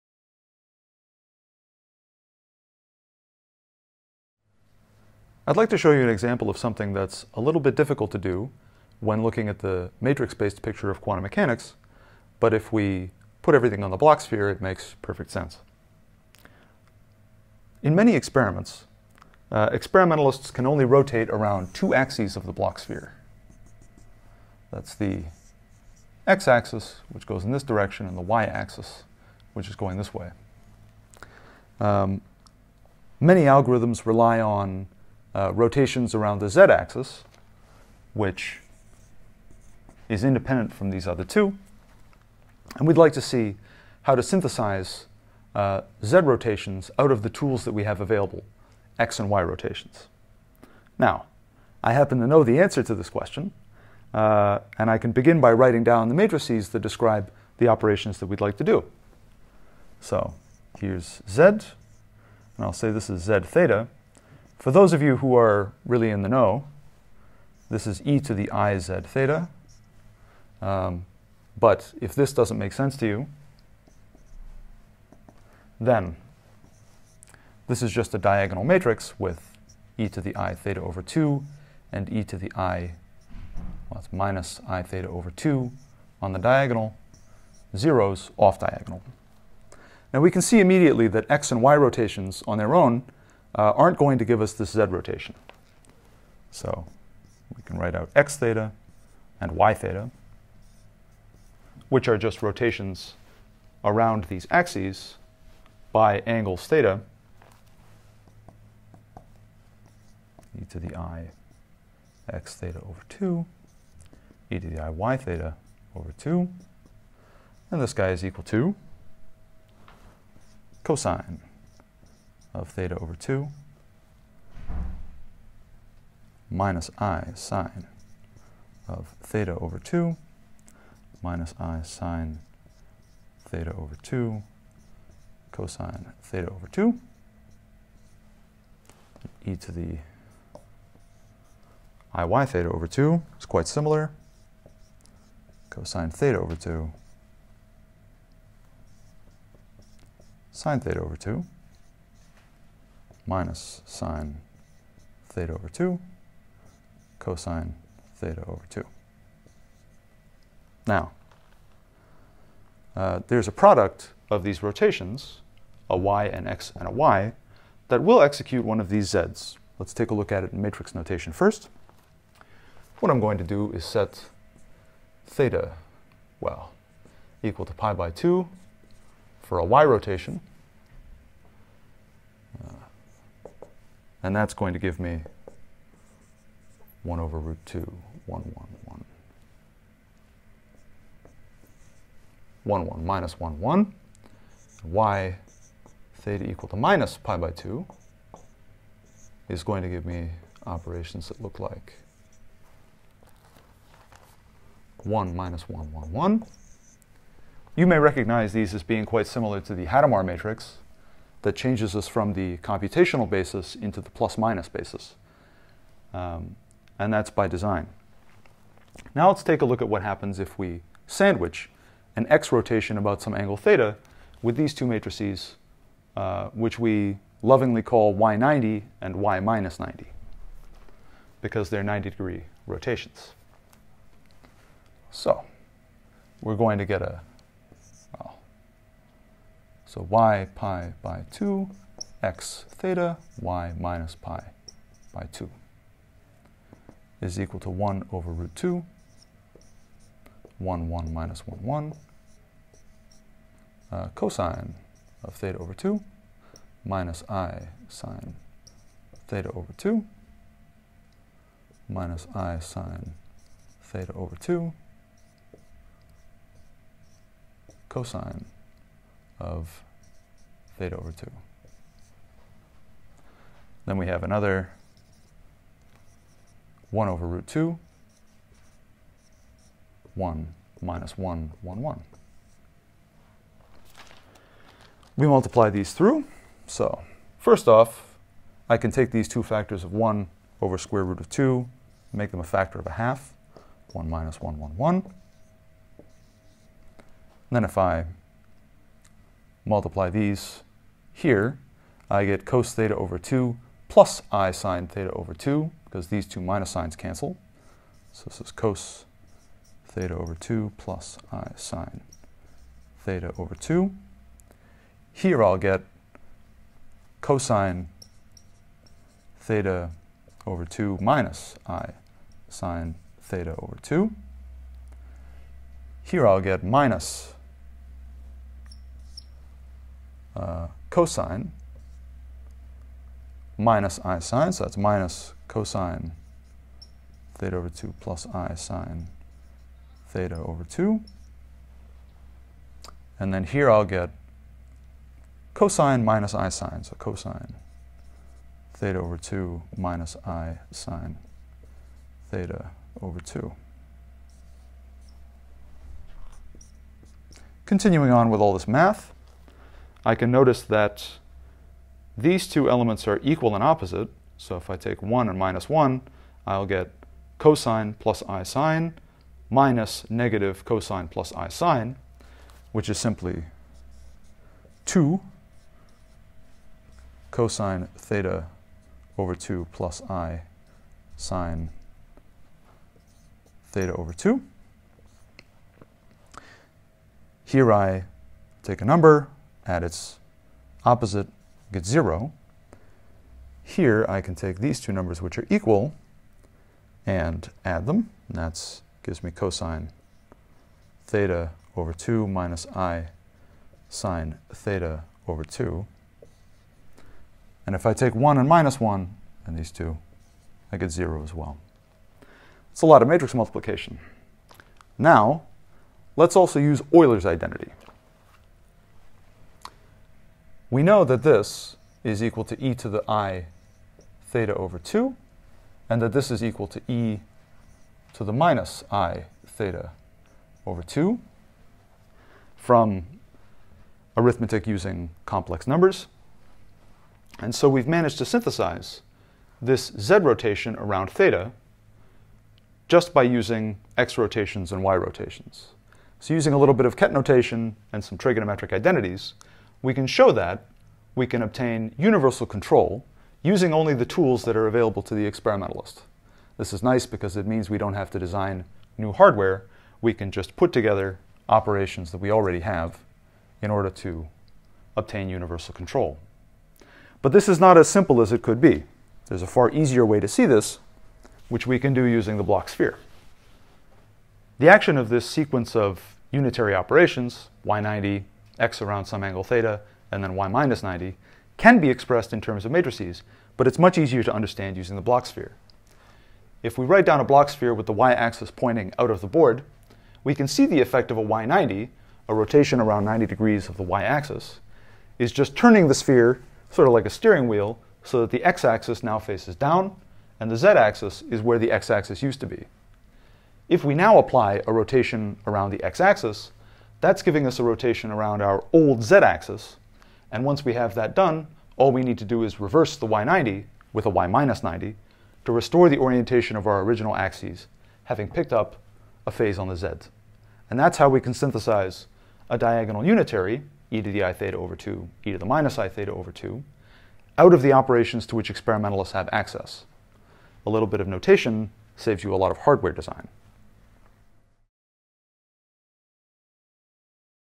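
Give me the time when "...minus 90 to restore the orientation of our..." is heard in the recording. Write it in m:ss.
8:34.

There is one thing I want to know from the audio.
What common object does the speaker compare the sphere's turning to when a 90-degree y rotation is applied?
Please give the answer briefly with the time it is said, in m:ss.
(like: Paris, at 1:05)
a steering wheel, at 8:17.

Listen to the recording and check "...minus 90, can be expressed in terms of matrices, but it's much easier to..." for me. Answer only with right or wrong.
right.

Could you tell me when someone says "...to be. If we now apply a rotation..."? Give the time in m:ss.
8:22.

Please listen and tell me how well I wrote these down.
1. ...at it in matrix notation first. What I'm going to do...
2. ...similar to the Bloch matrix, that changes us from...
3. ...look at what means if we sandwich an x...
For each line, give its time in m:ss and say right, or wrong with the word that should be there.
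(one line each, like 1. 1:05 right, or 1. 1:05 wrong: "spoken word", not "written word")
1. 2:50 right
2. 3:29 wrong: "Hadamard", not "Bloch"
3. 3:39 wrong: "happens", not "means".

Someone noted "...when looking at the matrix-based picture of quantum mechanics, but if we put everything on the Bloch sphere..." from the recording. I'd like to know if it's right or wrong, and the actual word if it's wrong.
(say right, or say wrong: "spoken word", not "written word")
right.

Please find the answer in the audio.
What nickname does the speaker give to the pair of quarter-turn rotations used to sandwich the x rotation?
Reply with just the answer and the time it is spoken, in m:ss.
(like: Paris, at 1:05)
y90 and y minus 90, at 3:48.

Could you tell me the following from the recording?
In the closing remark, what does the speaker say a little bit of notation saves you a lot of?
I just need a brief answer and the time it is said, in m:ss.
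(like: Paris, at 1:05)
hardware design, at 8:52.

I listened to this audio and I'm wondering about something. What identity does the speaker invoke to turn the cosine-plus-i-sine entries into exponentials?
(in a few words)
Euler's identity.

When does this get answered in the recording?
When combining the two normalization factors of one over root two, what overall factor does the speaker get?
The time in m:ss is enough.
4:52.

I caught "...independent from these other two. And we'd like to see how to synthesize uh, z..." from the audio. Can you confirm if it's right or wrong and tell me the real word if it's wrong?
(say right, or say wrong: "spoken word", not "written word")
right.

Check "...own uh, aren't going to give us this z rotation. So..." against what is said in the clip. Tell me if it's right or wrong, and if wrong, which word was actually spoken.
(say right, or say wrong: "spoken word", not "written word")
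right.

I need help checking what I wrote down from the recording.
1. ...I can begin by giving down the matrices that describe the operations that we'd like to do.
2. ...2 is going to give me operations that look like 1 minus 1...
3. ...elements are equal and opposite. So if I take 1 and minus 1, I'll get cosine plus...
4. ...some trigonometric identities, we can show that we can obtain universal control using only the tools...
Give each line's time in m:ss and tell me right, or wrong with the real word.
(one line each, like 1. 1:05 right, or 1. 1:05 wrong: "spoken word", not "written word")
1. 0:54 wrong: "writing", not "giving"
2. 3:17 right
3. 6:02 right
4. 7:28 right.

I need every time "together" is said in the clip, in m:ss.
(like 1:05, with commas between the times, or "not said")
7:40.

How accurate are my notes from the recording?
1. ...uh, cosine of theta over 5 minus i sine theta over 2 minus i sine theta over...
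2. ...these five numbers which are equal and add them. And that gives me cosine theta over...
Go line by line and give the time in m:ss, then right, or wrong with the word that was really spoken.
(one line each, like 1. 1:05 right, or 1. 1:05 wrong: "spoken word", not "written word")
1. 4:13 wrong: "2", not "5"
2. 6:34 wrong: "two", not "five".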